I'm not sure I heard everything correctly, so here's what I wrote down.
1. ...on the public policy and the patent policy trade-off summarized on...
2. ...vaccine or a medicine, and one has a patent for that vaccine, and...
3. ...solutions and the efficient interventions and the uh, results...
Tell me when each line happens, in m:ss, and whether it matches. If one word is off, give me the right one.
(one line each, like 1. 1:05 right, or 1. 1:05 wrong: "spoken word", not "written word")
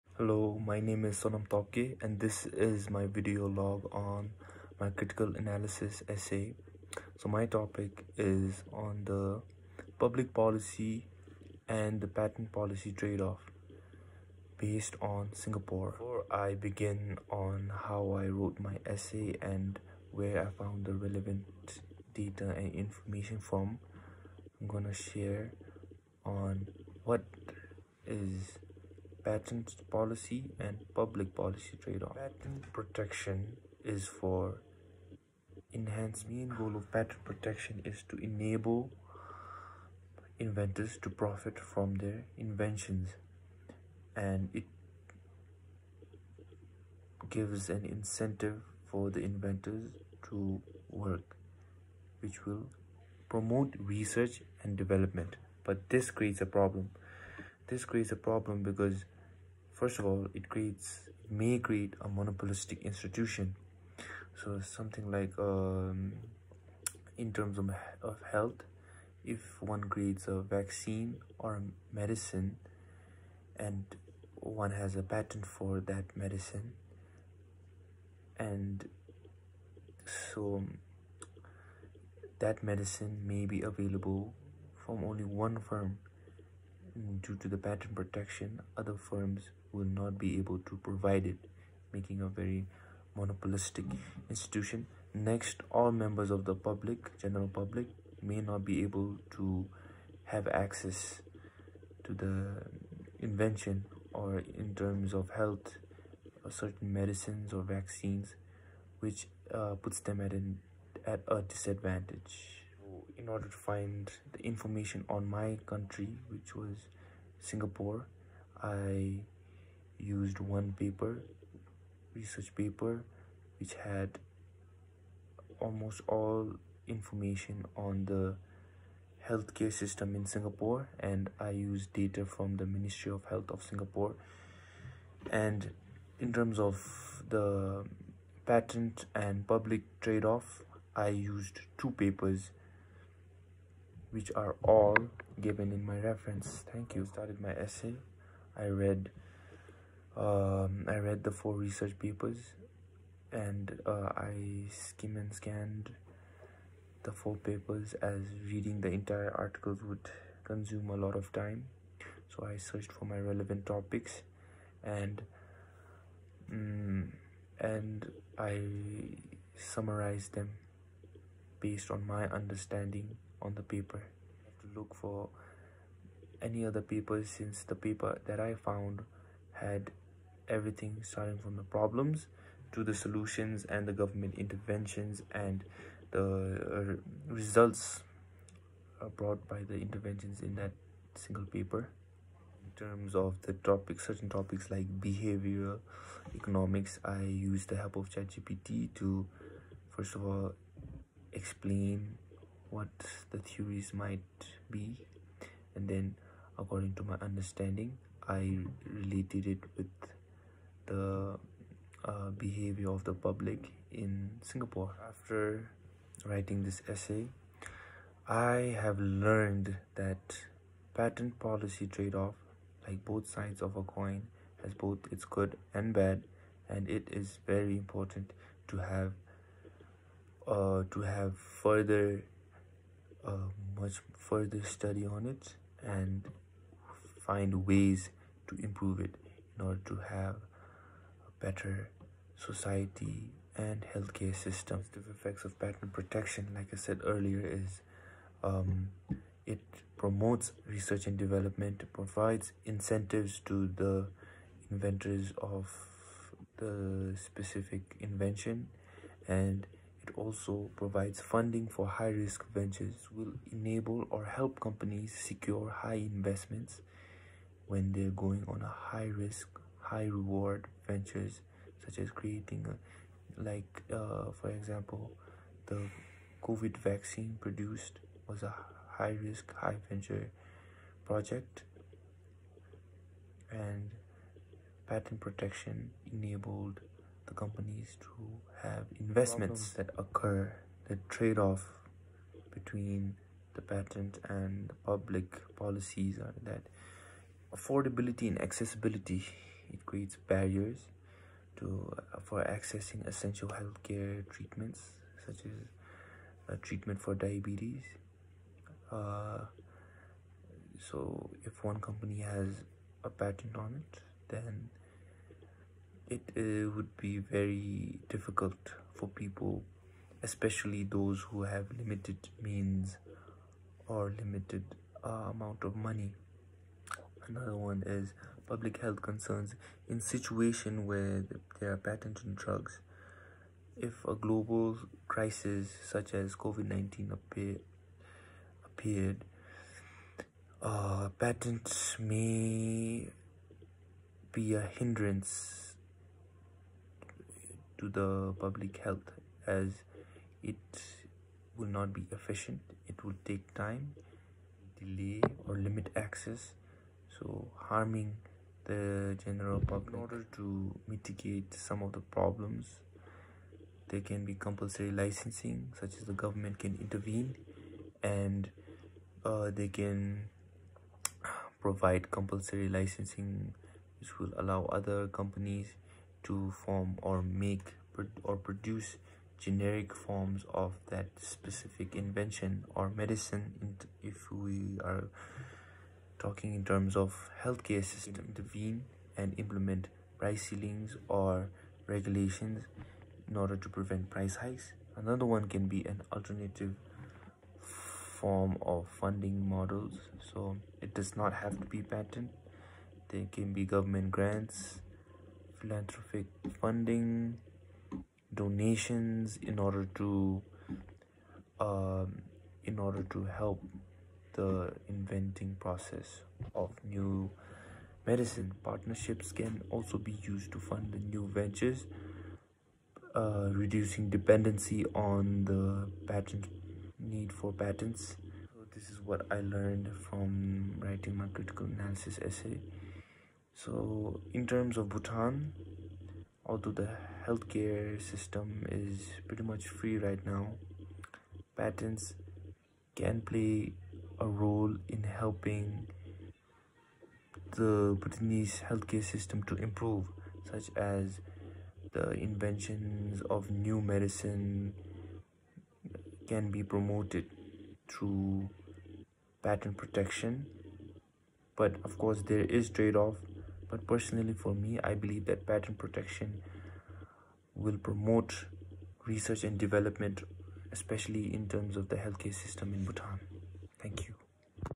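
1. 0:08 wrong: "based", not "summarized"
2. 1:10 wrong: "medicine", not "vaccine"
3. 3:02 wrong: "government", not "efficient".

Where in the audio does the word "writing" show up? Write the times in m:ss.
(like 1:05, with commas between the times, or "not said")
3:36, 7:10.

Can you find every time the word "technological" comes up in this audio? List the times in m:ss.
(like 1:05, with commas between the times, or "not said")
not said.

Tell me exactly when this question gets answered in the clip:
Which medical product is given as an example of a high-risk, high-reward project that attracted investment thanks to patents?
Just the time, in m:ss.
4:36.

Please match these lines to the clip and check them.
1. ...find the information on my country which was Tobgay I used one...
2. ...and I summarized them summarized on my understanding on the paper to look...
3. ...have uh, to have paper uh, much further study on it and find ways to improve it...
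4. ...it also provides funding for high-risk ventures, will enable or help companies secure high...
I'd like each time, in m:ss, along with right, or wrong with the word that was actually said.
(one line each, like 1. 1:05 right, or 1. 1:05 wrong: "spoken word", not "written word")
1. 1:53 wrong: "Singapore", not "Tobgay"
2. 2:47 wrong: "based", not "summarized"
3. 3:48 wrong: "further", not "paper"
4. 4:20 right.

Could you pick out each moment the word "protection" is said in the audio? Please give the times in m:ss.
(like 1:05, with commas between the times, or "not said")
0:32, 0:37, 1:27, 4:05, 4:45, 7:39, 7:45.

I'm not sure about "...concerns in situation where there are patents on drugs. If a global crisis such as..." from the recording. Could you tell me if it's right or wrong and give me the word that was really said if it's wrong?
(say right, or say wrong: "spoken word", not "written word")
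right.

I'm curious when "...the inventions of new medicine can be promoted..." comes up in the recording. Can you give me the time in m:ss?
7:31.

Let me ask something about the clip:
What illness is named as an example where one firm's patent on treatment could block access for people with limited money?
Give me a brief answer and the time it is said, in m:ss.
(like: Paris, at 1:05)
Diabetes, at 5:07.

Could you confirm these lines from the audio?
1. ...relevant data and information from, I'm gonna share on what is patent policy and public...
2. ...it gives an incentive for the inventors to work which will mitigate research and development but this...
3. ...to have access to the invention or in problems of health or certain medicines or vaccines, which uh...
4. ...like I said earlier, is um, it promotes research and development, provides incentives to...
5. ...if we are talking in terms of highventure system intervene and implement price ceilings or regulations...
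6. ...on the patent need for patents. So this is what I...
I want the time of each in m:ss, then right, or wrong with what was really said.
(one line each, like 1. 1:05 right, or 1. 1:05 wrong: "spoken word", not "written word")
1. 0:20 right
2. 0:44 wrong: "promote", not "mitigate"
3. 1:39 wrong: "terms", not "problems"
4. 4:06 right
5. 6:24 wrong: "healthcare", not "highventure"
6. 7:04 right.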